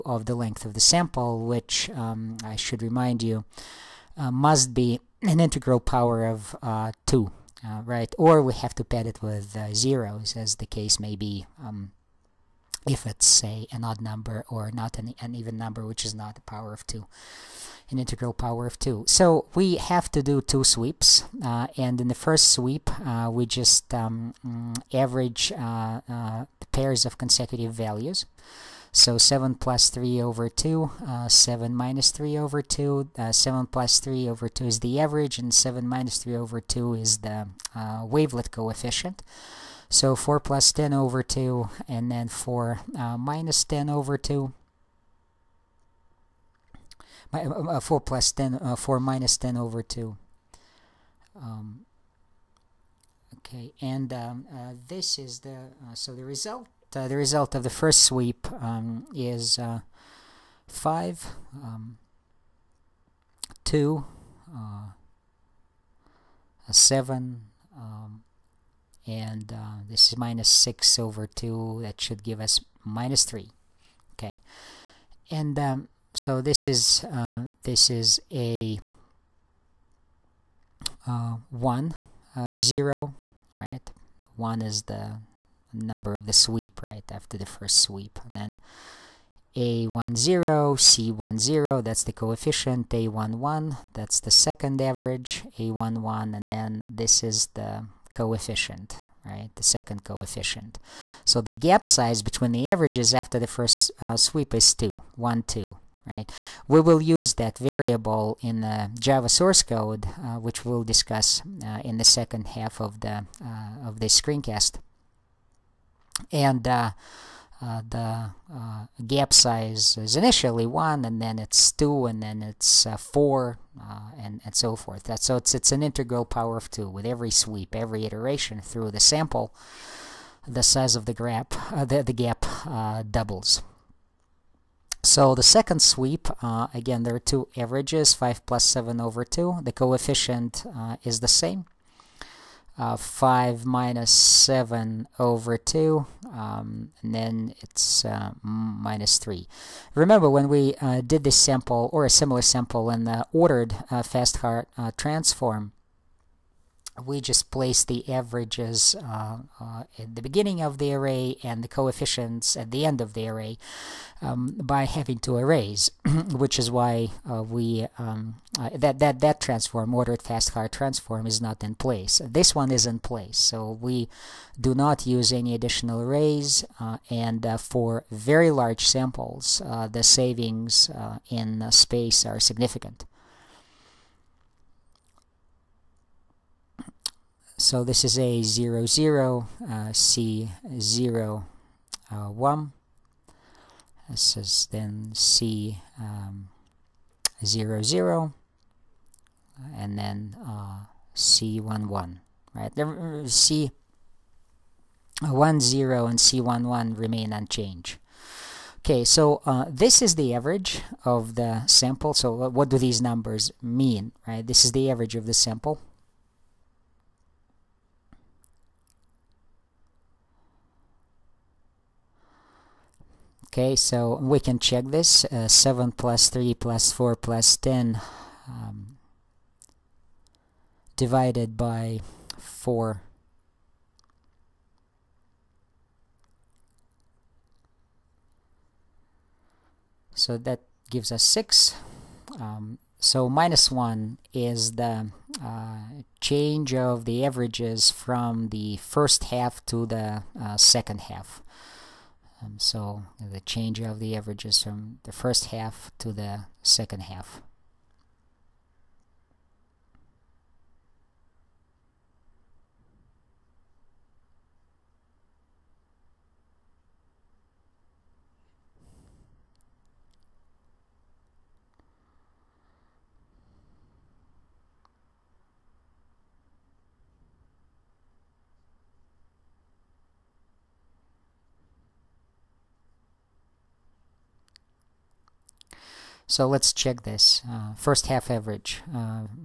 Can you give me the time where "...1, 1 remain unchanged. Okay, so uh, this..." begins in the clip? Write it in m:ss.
3:26.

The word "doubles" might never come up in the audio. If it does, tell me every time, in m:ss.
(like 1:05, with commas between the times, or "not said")
2:13.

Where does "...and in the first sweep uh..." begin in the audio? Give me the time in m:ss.
0:21.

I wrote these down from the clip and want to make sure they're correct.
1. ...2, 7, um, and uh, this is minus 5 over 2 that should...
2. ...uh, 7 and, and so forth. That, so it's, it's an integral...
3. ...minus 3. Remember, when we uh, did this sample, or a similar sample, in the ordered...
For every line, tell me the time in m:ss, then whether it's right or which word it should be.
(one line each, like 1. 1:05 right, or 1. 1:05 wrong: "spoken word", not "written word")
1. 1:03 wrong: "6", not "5"
2. 2:02 wrong: "4", not "7"
3. 2:28 right.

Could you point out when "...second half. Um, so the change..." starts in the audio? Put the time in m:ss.
4:10.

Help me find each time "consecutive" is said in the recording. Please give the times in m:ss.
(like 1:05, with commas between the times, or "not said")
0:27.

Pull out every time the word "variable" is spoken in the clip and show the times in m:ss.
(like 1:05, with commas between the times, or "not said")
1:47.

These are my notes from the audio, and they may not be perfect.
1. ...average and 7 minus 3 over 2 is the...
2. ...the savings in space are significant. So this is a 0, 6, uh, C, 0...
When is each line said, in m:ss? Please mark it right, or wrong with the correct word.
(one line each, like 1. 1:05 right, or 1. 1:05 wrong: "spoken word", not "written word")
1. 0:34 right
2. 2:59 wrong: "0", not "6".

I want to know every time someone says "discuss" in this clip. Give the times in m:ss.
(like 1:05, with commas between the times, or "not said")
1:50.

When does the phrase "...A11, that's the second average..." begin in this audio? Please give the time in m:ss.
1:32.